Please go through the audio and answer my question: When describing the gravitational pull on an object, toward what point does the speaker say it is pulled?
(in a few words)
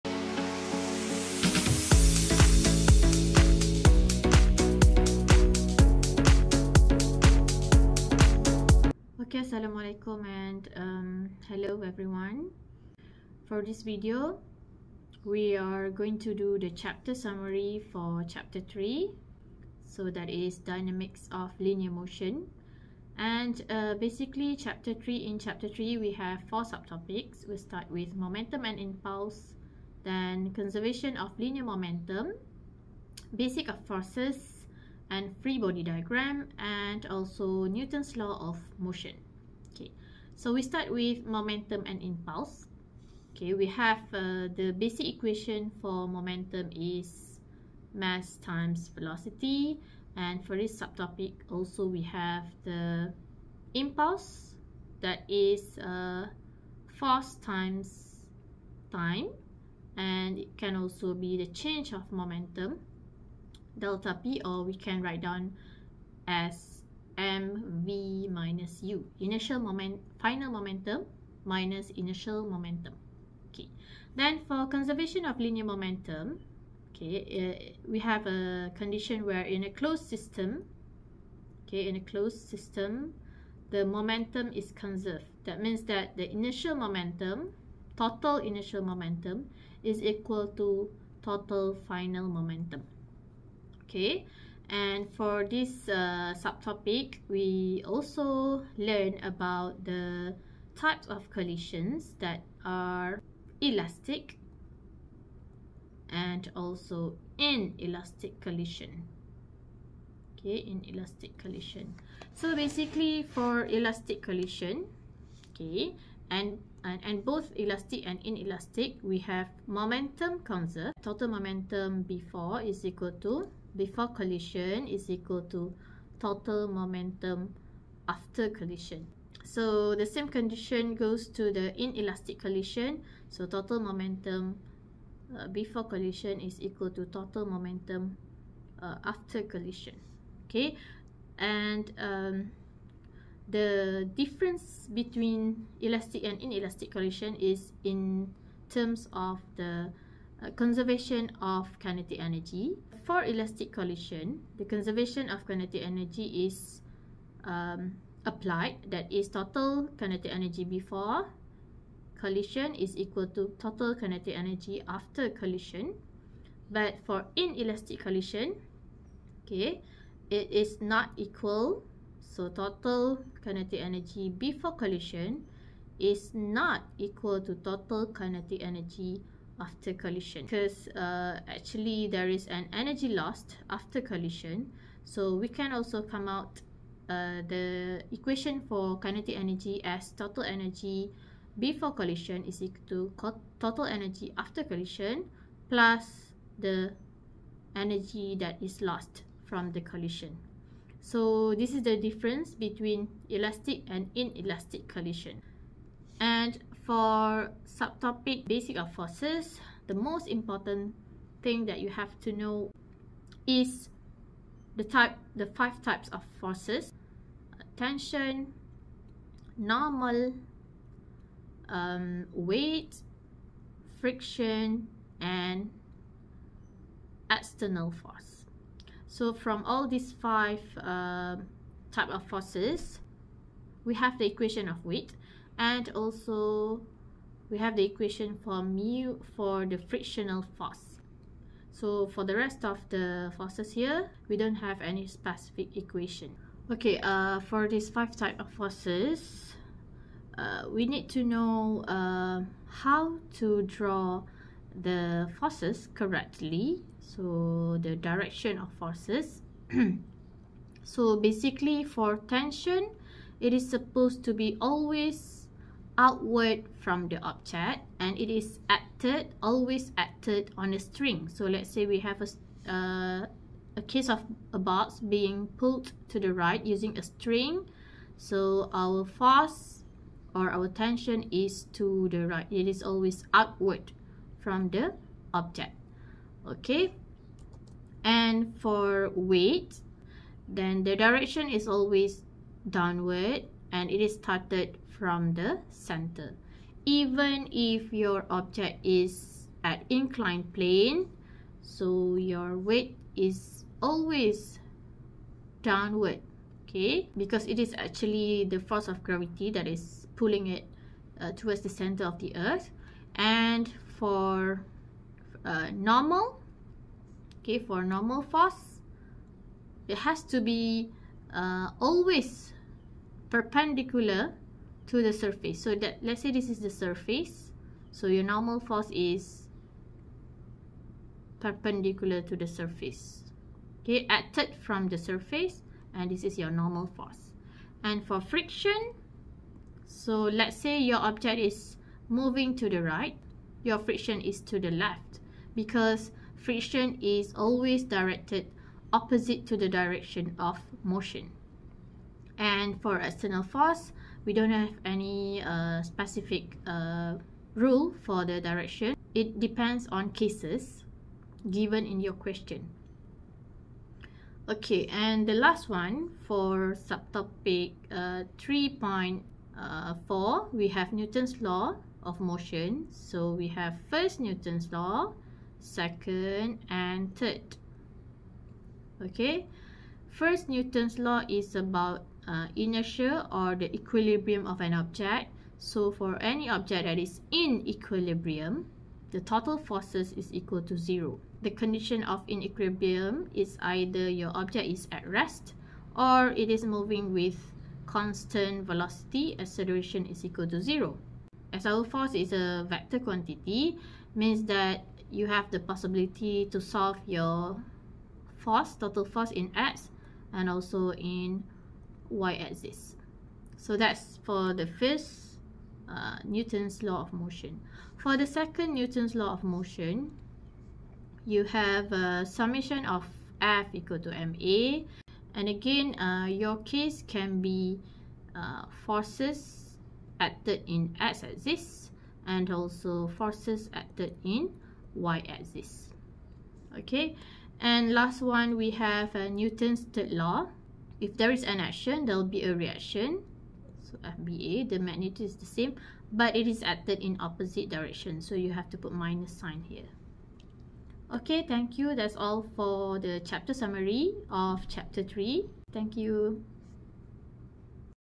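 Center of the earth.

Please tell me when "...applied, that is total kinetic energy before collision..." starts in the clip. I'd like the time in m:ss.
2:38.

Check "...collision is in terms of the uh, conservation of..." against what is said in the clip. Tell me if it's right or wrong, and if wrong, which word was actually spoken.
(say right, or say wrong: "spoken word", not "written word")
right.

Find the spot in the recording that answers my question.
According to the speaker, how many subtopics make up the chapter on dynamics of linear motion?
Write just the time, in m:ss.
0:26.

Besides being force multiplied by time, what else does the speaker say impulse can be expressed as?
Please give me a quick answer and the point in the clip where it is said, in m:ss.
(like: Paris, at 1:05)
Change of momentum, at 1:01.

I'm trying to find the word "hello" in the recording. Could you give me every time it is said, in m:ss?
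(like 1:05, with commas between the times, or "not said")
0:11.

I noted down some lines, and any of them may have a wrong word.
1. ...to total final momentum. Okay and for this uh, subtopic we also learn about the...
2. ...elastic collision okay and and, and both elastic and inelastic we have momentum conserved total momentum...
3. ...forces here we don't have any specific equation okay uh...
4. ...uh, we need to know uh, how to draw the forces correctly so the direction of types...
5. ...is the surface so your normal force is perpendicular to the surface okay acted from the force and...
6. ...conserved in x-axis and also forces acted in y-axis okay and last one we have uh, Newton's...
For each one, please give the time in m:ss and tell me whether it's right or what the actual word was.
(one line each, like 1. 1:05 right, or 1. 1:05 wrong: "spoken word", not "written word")
1. 1:30 right
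2. 1:53 right
3. 4:03 right
4. 4:10 wrong: "forces", not "types"
5. 5:26 wrong: "surface", not "force"
6. 7:10 wrong: "acted", not "conserved".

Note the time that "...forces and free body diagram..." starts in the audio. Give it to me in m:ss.
0:33.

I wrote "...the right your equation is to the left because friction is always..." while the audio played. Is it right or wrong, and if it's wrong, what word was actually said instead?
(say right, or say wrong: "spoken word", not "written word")
wrong: "friction", not "equation".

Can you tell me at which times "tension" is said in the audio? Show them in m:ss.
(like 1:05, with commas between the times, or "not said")
3:37, 4:22, 4:40.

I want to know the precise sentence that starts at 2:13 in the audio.
So total momentum uh, before collision is equal to total momentum uh, after collision.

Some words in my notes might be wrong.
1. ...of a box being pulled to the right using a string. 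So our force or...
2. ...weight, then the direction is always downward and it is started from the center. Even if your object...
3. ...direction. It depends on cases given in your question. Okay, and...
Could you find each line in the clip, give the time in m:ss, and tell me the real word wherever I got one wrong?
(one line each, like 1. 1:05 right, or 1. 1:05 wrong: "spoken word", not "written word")
1. 4:34 right
2. 4:49 right
3. 5:58 right.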